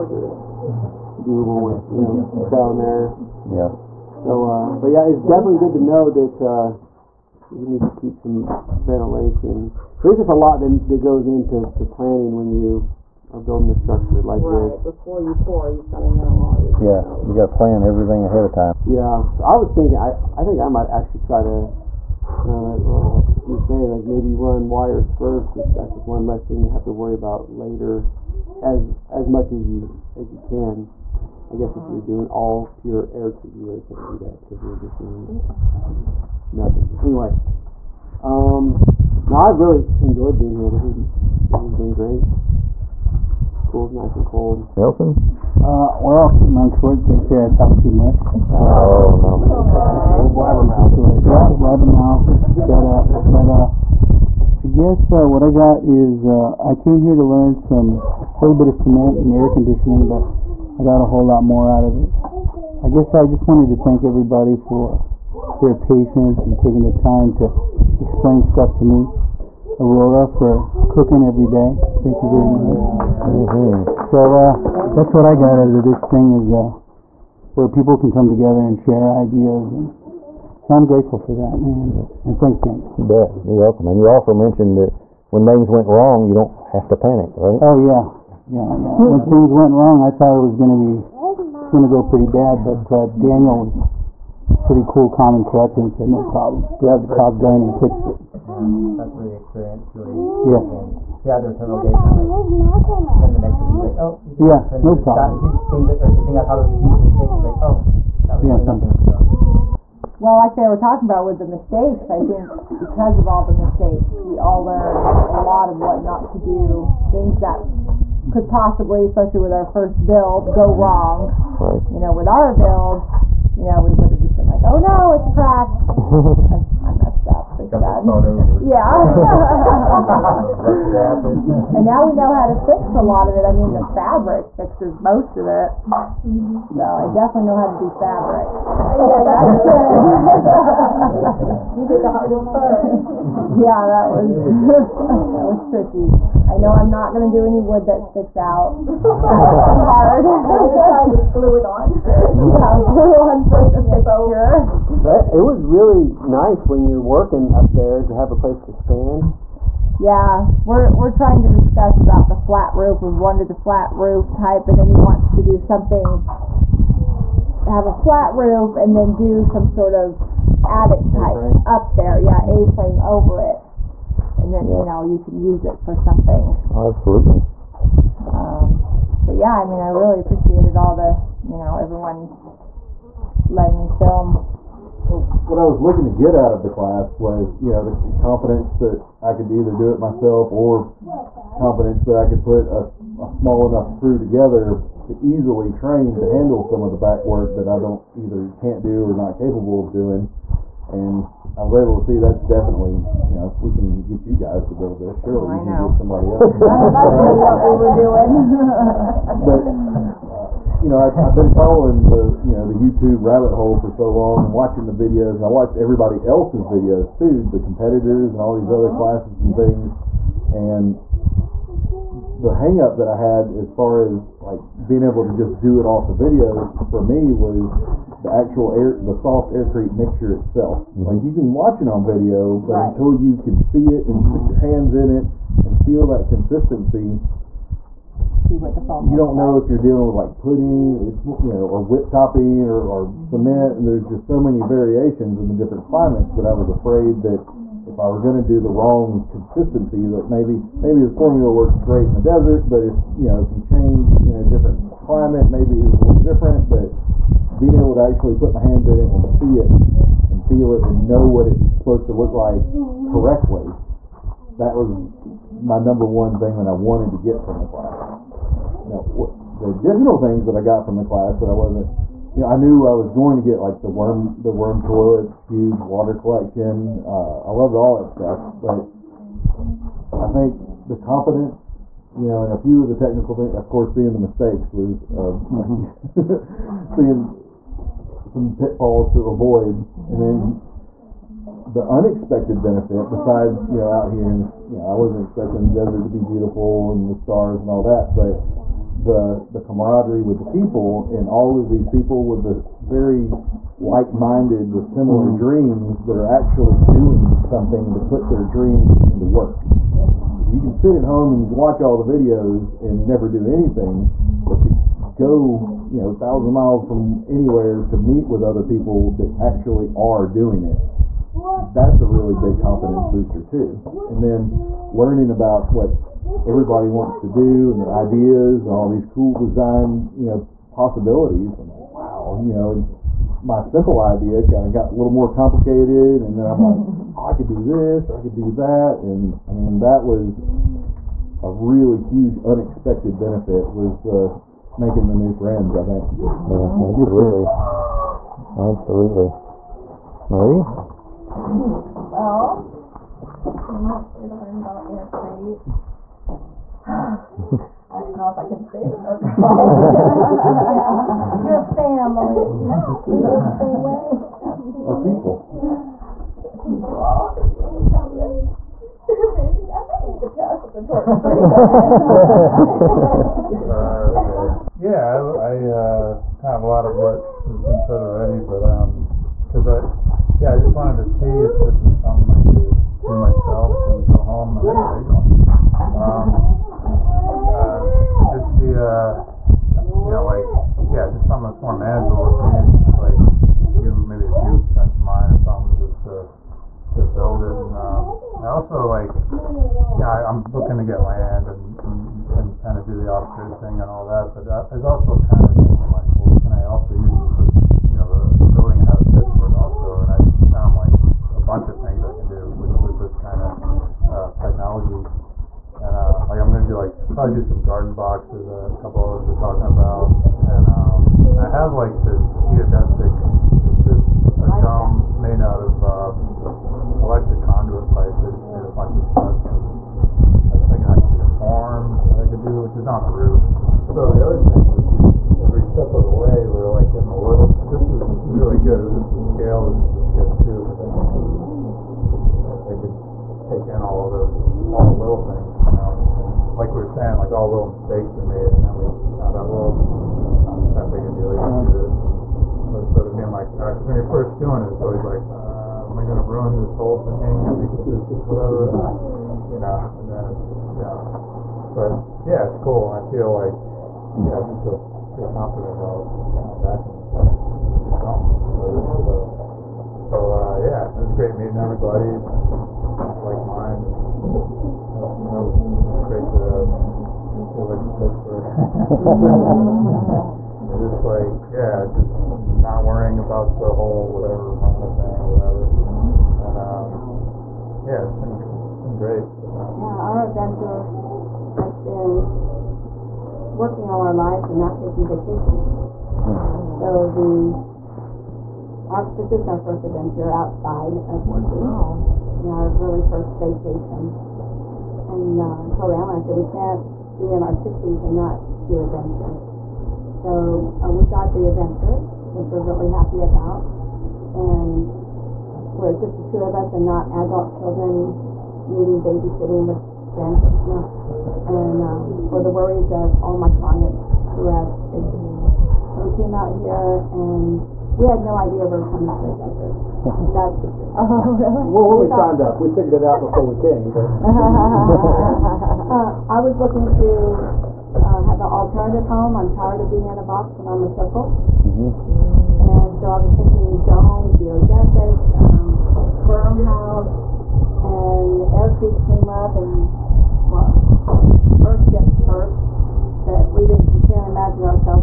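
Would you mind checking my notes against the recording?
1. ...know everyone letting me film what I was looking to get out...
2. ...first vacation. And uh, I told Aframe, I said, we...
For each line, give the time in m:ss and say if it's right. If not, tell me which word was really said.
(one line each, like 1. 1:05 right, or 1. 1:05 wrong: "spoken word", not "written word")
1. 3:01 right
2. 8:23 wrong: "Alan", not "Aframe".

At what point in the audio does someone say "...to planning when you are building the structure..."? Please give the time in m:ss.
0:11.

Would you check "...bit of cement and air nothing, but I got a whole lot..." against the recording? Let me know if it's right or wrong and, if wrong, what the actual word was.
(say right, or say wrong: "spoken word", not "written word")
wrong: "conditioning", not "nothing".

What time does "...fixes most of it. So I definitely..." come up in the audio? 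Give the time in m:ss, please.
2:14.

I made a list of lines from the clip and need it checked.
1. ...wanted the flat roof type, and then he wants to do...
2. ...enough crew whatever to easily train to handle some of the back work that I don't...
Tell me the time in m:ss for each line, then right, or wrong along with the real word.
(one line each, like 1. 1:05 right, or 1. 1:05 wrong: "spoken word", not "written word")
1. 2:43 right
2. 3:13 wrong: "together", not "whatever".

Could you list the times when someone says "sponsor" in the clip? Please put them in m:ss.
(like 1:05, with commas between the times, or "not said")
not said.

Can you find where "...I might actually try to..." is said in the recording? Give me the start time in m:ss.
0:20.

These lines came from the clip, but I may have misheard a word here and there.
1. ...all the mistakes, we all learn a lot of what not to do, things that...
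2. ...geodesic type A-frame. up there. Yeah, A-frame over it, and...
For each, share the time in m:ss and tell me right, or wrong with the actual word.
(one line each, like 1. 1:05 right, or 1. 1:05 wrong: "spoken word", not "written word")
1. 1:53 right
2. 2:50 wrong: "attic", not "geodesic".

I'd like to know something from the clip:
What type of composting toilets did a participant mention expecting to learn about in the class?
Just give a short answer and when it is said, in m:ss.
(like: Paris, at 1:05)
worm toilets, at 4:34.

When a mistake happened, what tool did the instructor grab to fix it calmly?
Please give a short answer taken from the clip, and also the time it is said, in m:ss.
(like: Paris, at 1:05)
caulk gun, at 1:37.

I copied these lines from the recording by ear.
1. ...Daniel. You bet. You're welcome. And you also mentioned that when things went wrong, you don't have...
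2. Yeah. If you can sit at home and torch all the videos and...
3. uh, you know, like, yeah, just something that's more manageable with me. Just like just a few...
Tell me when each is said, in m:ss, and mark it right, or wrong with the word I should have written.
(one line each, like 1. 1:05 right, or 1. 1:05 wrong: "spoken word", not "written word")
1. 1:22 right
2. 5:09 wrong: "watch", not "torch"
3. 6:28 right.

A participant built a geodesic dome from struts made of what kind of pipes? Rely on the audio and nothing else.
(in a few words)
electric conduit pipes.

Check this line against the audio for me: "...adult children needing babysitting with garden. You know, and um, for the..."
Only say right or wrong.
wrong.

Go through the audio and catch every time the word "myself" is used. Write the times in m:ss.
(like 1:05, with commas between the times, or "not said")
3:09, 6:23.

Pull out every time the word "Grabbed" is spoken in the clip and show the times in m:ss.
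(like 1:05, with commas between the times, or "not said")
1:36.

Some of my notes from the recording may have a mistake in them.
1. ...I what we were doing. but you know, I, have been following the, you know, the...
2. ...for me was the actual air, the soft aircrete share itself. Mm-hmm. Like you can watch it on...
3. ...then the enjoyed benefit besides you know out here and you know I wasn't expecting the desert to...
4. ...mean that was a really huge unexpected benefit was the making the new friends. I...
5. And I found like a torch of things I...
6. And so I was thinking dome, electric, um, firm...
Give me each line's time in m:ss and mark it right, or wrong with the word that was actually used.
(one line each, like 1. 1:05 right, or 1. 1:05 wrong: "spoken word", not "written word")
1. 3:26 right
2. 3:46 wrong: "mixture", not "share"
3. 4:50 wrong: "unexpected", not "enjoyed"
4. 5:39 right
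5. 6:49 wrong: "bunch", not "torch"
6. 9:02 wrong: "geodesic", not "electric".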